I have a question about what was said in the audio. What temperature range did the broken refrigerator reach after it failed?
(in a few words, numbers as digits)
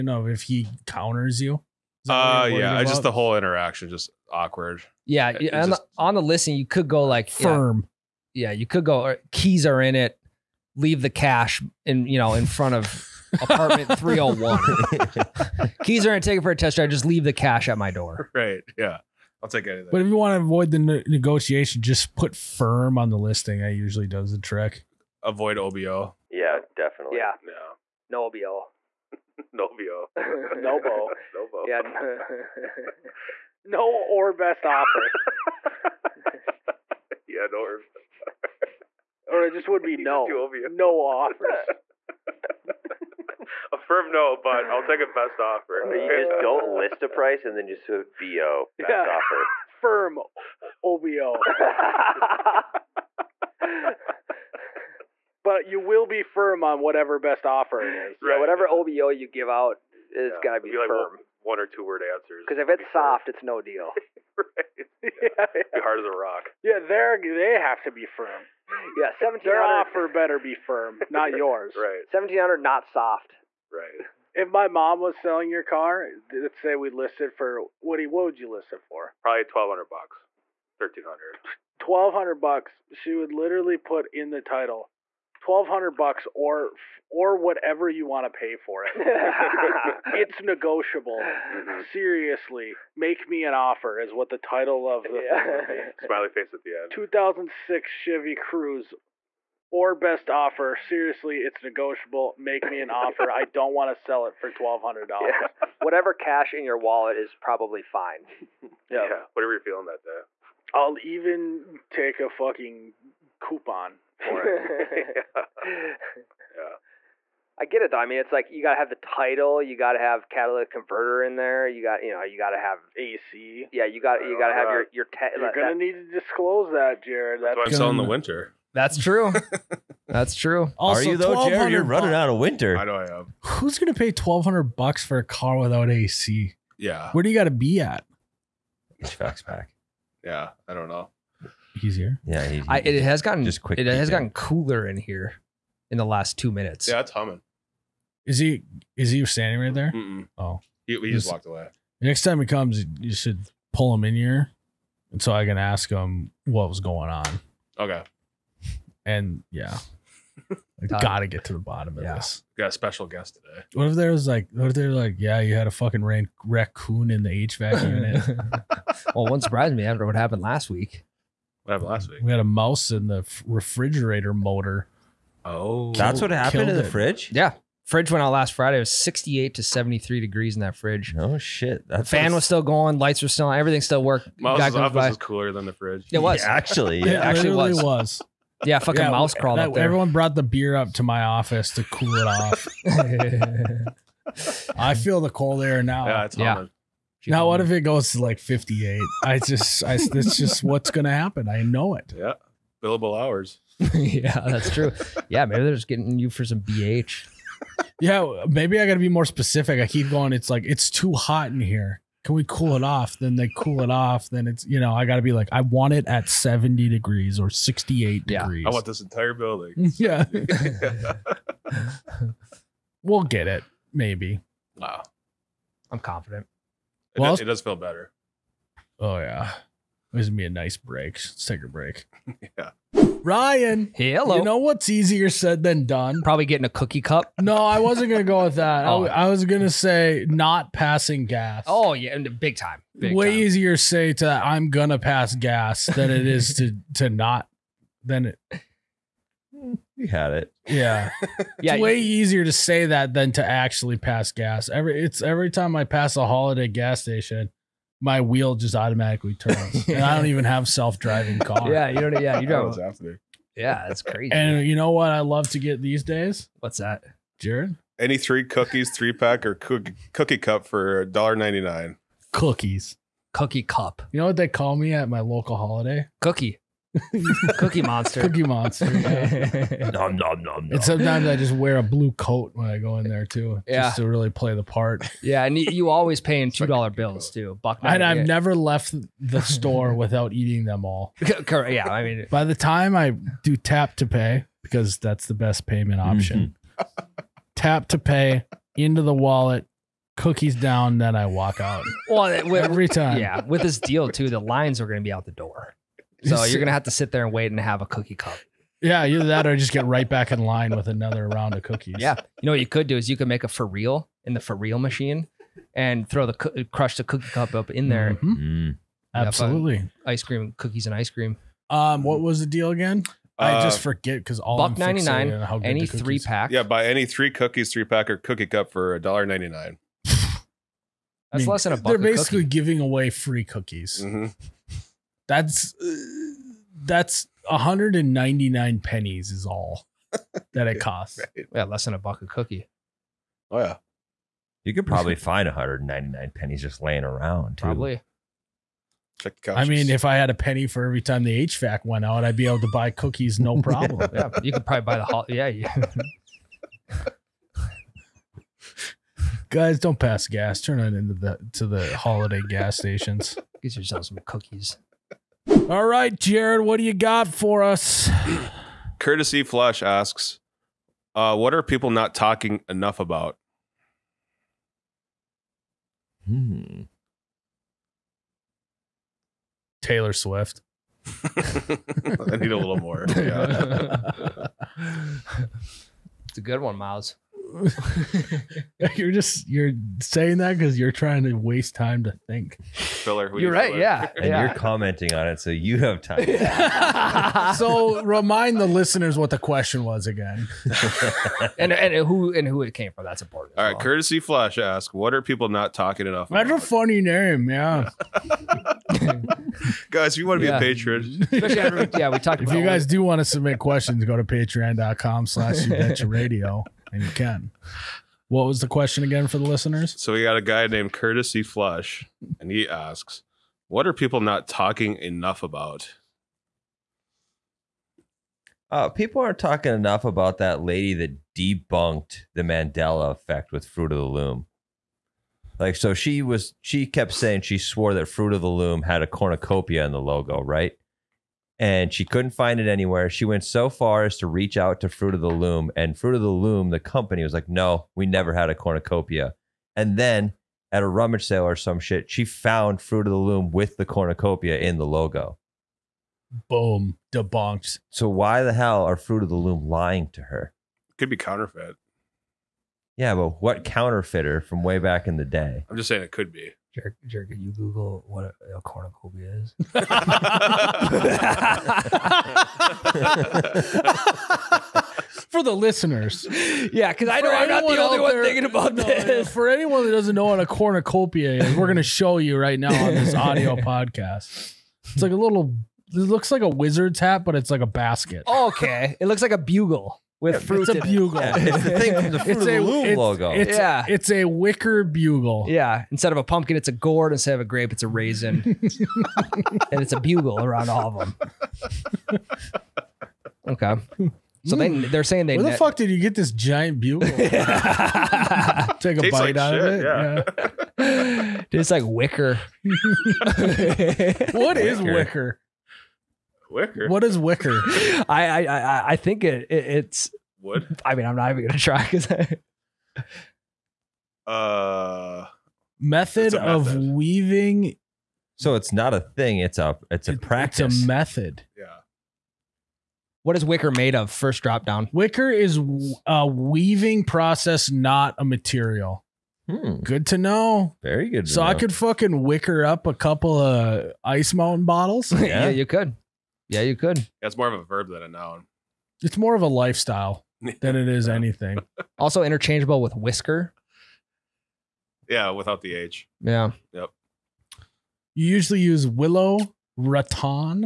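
68 to 73 degrees.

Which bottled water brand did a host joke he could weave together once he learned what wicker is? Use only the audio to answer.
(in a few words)
Ice Mountain.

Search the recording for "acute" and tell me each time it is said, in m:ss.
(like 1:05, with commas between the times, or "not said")
not said.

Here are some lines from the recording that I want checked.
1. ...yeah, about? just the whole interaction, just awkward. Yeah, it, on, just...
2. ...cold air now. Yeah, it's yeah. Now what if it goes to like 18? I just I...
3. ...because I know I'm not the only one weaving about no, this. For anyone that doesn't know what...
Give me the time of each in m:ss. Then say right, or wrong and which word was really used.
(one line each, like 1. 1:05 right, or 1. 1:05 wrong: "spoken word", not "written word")
1. 0:02 right
2. 3:15 wrong: "58", not "18"
3. 7:56 wrong: "thinking", not "weaving".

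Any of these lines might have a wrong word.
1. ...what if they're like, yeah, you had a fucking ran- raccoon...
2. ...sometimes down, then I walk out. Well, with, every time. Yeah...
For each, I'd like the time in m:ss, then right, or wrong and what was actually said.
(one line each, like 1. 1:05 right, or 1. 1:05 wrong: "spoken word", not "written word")
1. 2:44 right
2. 5:00 wrong: "cookies", not "sometimes".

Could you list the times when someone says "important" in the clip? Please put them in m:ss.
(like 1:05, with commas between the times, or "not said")
6:43.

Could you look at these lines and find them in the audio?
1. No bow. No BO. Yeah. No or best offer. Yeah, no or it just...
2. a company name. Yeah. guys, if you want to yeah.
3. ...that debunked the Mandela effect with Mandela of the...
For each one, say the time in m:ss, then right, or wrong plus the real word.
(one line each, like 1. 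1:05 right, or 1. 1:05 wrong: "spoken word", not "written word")
1. 0:30 right
2. 6:46 wrong: "funny", not "company"
3. 7:10 wrong: "Fruit", not "Mandela".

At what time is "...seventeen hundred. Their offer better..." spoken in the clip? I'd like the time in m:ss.
1:09.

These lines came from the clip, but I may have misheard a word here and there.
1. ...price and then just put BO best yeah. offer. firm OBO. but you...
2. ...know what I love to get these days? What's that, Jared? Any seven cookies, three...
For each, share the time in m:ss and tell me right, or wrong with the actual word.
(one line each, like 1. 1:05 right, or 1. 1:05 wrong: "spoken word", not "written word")
1. 0:47 right
2. 4:24 wrong: "three", not "seven".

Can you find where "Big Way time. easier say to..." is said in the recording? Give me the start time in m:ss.
4:02.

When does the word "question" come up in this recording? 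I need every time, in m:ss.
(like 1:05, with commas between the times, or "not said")
6:39, 6:53, 6:58.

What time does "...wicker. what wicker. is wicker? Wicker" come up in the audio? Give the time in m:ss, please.
8:31.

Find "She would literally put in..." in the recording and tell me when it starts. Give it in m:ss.
1:22.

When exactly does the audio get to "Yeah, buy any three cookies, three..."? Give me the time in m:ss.
5:26.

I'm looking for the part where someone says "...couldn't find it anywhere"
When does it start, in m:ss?
7:22.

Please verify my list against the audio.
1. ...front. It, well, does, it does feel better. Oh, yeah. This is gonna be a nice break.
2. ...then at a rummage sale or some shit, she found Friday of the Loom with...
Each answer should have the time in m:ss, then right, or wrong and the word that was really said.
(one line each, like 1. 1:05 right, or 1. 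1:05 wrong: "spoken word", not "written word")
1. 3:45 wrong: "confident", not "front"
2. 7:29 wrong: "Fruit", not "Friday".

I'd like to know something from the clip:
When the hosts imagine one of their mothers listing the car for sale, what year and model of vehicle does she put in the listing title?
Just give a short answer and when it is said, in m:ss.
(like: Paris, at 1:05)
2006 Chevy Cruze, at 1:36.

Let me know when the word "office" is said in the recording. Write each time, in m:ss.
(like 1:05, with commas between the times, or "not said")
3:04, 3:11.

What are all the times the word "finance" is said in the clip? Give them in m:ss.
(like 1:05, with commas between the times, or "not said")
not said.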